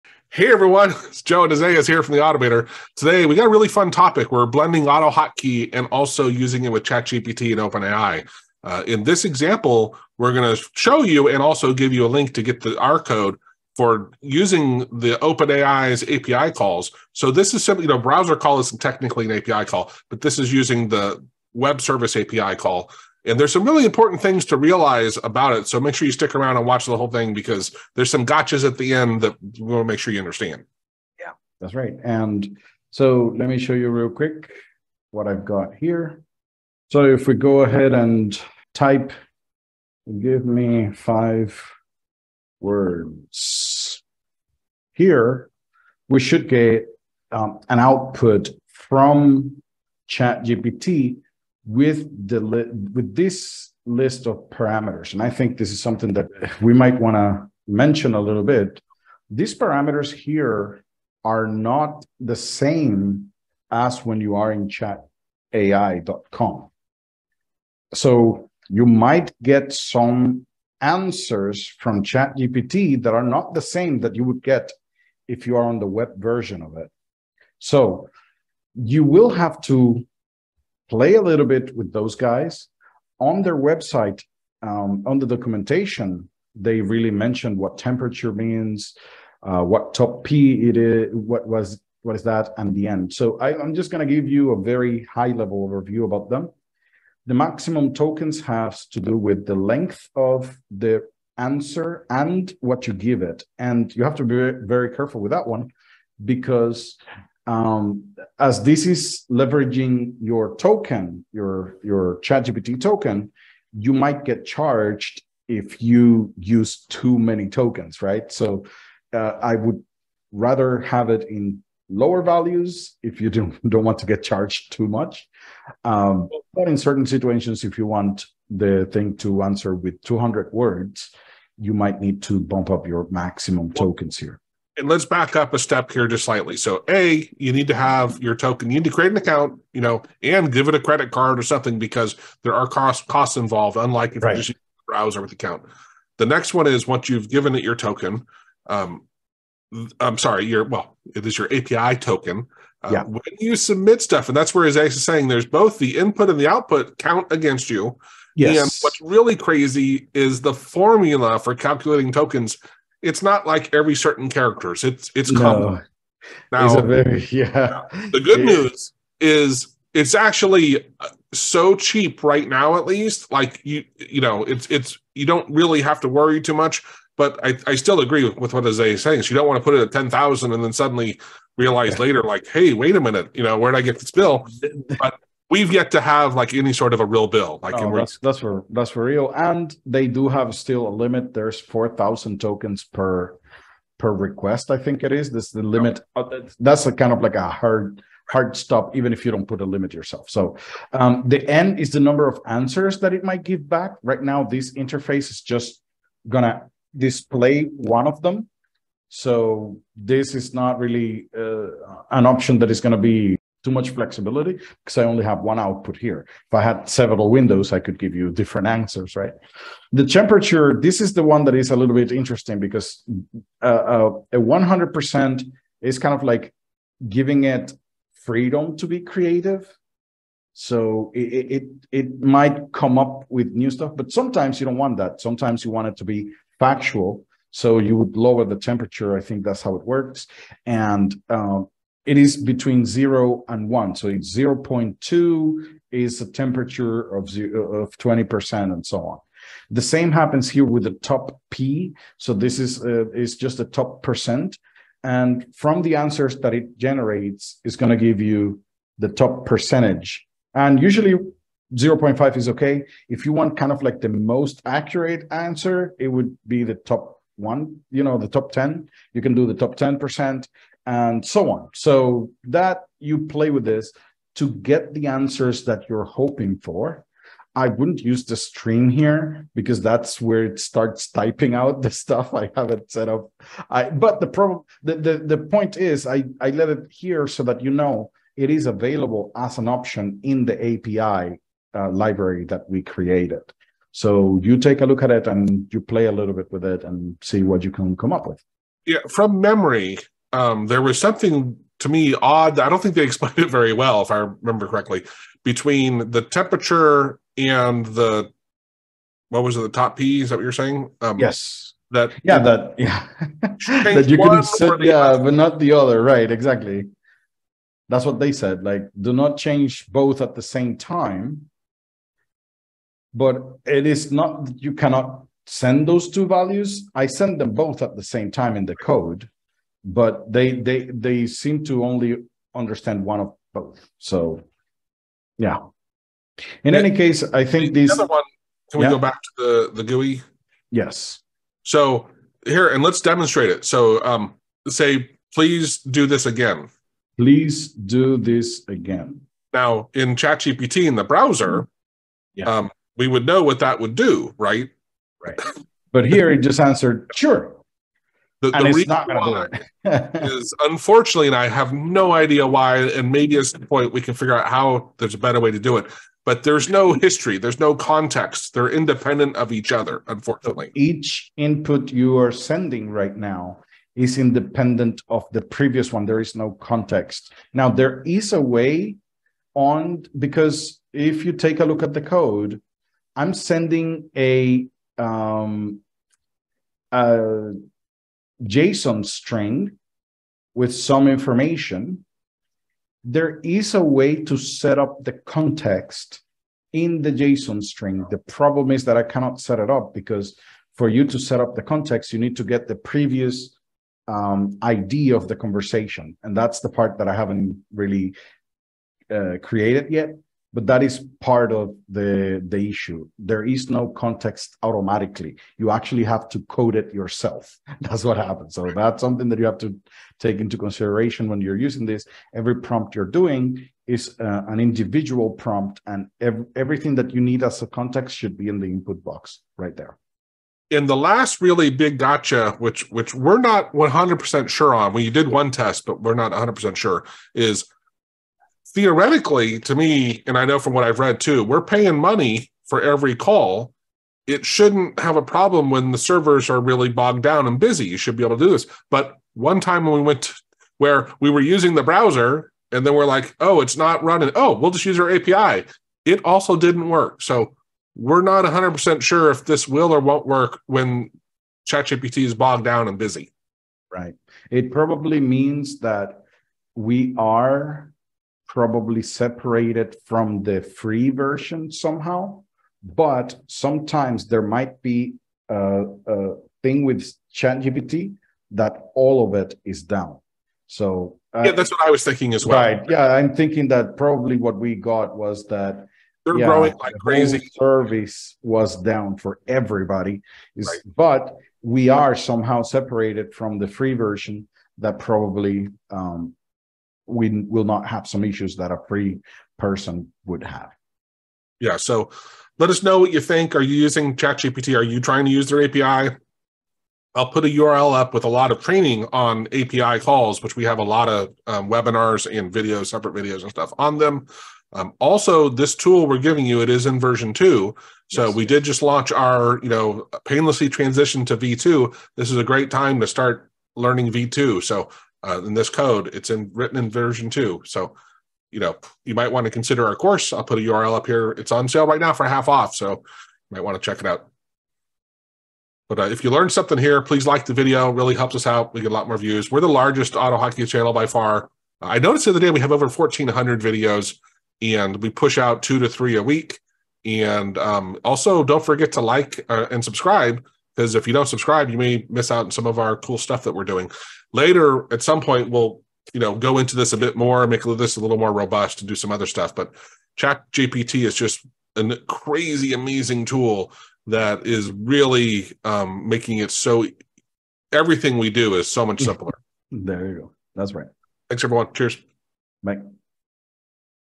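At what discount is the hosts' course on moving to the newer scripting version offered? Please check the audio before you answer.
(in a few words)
half off.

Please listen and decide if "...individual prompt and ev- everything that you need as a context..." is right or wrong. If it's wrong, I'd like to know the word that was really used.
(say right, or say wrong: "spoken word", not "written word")
right.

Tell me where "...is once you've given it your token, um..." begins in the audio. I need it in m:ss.
2:26.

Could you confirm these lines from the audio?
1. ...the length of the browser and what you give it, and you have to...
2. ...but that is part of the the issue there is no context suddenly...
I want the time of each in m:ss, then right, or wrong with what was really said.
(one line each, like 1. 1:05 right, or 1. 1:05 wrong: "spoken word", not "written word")
1. 1:39 wrong: "answer", not "browser"
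2. 6:50 wrong: "automatically", not "suddenly".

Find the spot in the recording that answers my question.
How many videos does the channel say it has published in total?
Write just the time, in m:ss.
9:02.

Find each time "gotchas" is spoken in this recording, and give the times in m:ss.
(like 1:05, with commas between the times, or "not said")
0:28, 7:11.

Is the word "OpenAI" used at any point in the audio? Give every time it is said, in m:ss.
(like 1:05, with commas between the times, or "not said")
0:07, 0:15.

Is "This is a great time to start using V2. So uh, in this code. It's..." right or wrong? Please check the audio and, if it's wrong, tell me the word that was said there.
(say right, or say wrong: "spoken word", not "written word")
wrong: "learning", not "using".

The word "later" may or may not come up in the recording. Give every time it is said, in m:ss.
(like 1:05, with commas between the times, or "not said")
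3:01, 9:14.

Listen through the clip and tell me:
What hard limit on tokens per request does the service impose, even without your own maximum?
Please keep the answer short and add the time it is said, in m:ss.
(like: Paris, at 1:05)
4000, at 3:11.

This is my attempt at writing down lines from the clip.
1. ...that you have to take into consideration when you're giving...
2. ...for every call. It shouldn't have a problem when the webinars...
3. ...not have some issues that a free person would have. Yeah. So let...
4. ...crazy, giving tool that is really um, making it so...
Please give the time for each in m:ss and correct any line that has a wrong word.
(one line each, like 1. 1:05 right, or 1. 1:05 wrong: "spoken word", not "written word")
1. 6:59 wrong: "using", not "giving"
2. 7:22 wrong: "servers", not "webinars"
3. 8:17 right
4. 9:22 wrong: "amazing", not "giving".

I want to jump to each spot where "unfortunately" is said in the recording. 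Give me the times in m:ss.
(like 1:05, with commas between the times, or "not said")
6:00, 6:10.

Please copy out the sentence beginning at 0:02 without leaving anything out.
Today we got a really fun topic.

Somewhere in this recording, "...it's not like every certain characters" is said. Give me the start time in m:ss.
2:43.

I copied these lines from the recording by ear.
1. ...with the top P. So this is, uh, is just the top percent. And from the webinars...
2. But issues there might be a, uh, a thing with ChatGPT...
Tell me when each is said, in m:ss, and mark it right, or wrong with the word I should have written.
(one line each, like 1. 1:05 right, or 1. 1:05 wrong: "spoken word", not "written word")
1. 4:10 wrong: "answers", not "webinars"
2. 7:52 wrong: "sometimes", not "issues".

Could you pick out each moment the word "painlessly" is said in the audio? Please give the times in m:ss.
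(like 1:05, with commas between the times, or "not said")
8:40.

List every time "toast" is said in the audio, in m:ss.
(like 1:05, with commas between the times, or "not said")
not said.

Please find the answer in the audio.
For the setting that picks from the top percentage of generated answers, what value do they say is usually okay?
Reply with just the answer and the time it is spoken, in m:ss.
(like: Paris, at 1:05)
0.5, at 4:21.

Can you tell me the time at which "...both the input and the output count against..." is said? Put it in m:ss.
2:35.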